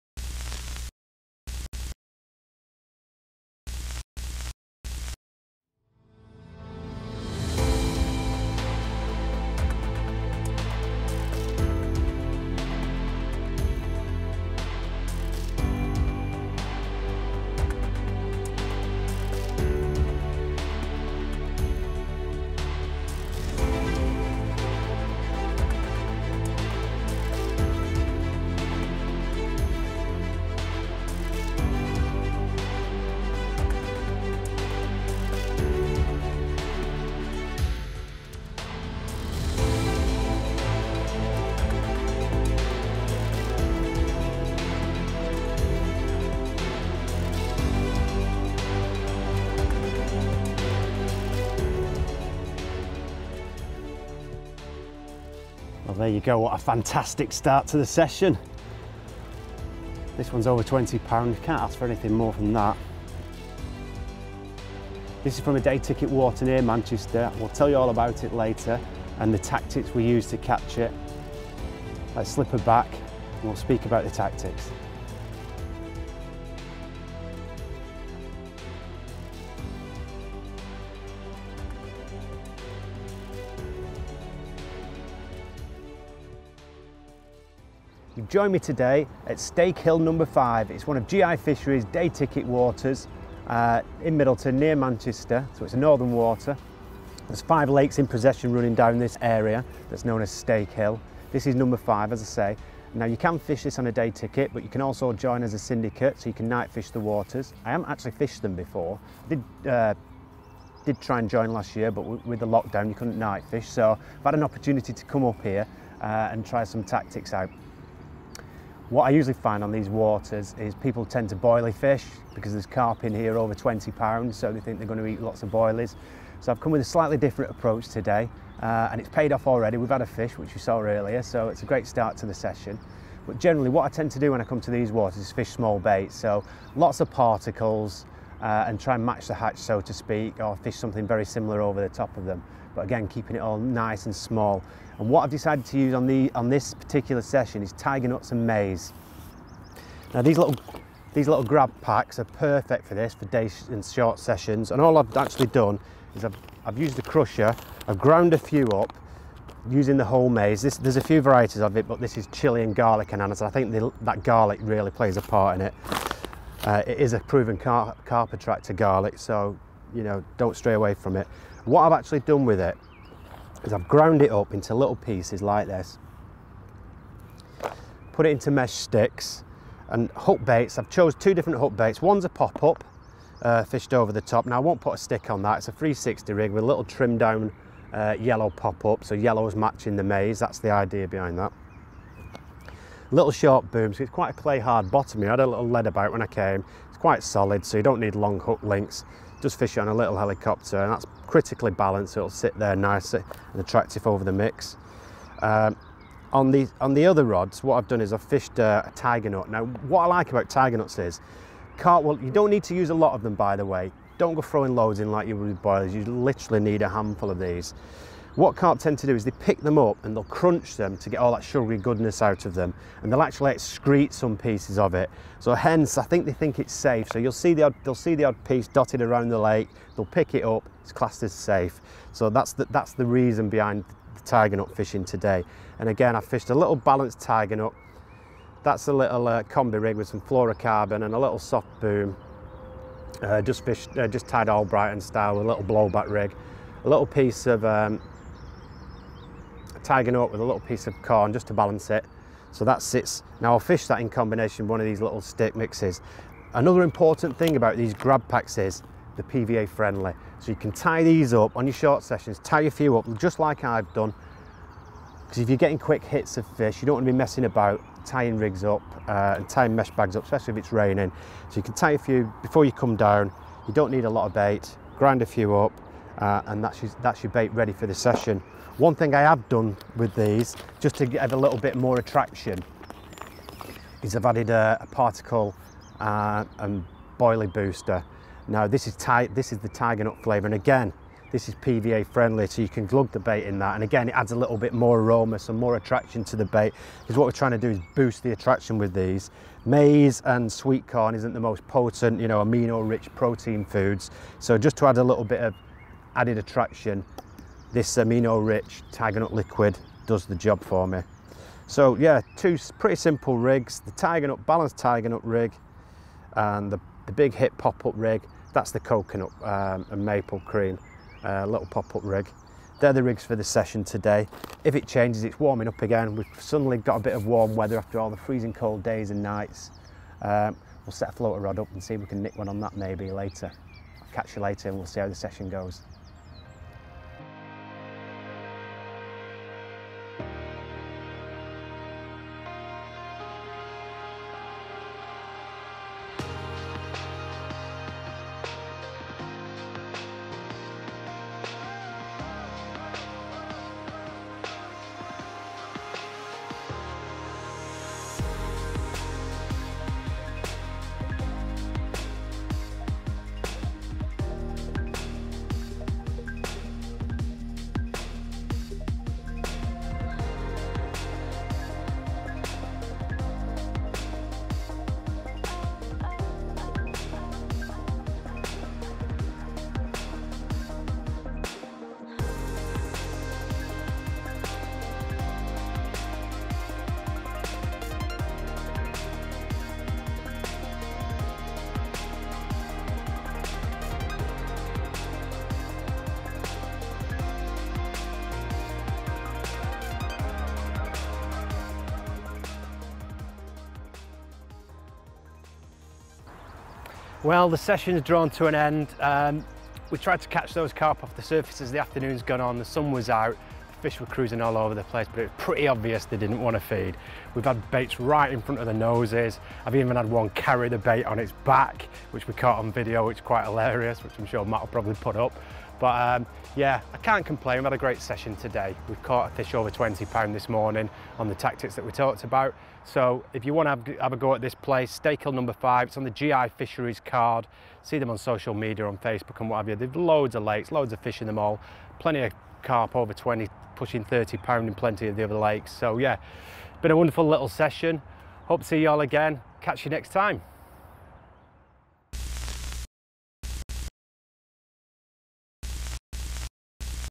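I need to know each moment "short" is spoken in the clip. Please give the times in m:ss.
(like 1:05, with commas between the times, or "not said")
2:33, 3:13, 4:21.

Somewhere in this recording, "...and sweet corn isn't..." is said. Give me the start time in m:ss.
5:00.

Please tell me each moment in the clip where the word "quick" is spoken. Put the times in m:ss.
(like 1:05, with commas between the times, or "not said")
4:25.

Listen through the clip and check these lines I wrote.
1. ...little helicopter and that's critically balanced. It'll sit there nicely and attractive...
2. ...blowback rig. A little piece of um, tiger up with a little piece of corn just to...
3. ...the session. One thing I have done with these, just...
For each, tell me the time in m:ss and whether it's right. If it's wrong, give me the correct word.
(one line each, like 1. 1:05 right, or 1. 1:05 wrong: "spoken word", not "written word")
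1. 3:19 right
2. 4:05 right
3. 4:37 right.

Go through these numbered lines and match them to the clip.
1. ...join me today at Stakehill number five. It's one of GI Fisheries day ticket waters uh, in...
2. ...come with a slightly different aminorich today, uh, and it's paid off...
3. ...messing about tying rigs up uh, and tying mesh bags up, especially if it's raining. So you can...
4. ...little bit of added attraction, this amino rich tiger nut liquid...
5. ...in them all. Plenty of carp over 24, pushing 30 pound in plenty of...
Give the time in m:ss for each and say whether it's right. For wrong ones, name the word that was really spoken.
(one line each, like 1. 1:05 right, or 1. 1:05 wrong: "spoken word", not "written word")
1. 1:28 right
2. 2:06 wrong: "approach", not "aminorich"
3. 4:27 right
4. 5:05 right
5. 7:21 wrong: "20", not "24".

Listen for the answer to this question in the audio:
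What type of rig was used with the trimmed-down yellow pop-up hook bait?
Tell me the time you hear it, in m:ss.
3:05.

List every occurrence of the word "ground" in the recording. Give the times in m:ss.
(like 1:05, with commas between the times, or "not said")
2:37, 2:53.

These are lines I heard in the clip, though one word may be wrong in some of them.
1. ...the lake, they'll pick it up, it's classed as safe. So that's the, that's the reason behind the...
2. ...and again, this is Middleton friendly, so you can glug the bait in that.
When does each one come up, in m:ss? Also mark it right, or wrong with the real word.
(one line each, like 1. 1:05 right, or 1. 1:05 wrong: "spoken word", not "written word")
1. 3:49 right
2. 4:50 wrong: "PVA", not "Middleton".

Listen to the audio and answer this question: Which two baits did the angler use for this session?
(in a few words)
Tiger nuts and maize.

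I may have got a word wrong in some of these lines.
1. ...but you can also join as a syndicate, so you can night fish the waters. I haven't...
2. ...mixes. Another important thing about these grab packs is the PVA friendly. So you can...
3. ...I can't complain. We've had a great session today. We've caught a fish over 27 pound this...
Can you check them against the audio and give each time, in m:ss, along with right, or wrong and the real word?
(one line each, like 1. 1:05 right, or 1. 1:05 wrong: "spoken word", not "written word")
1. 1:44 right
2. 4:15 right
3. 7:06 wrong: "20", not "27".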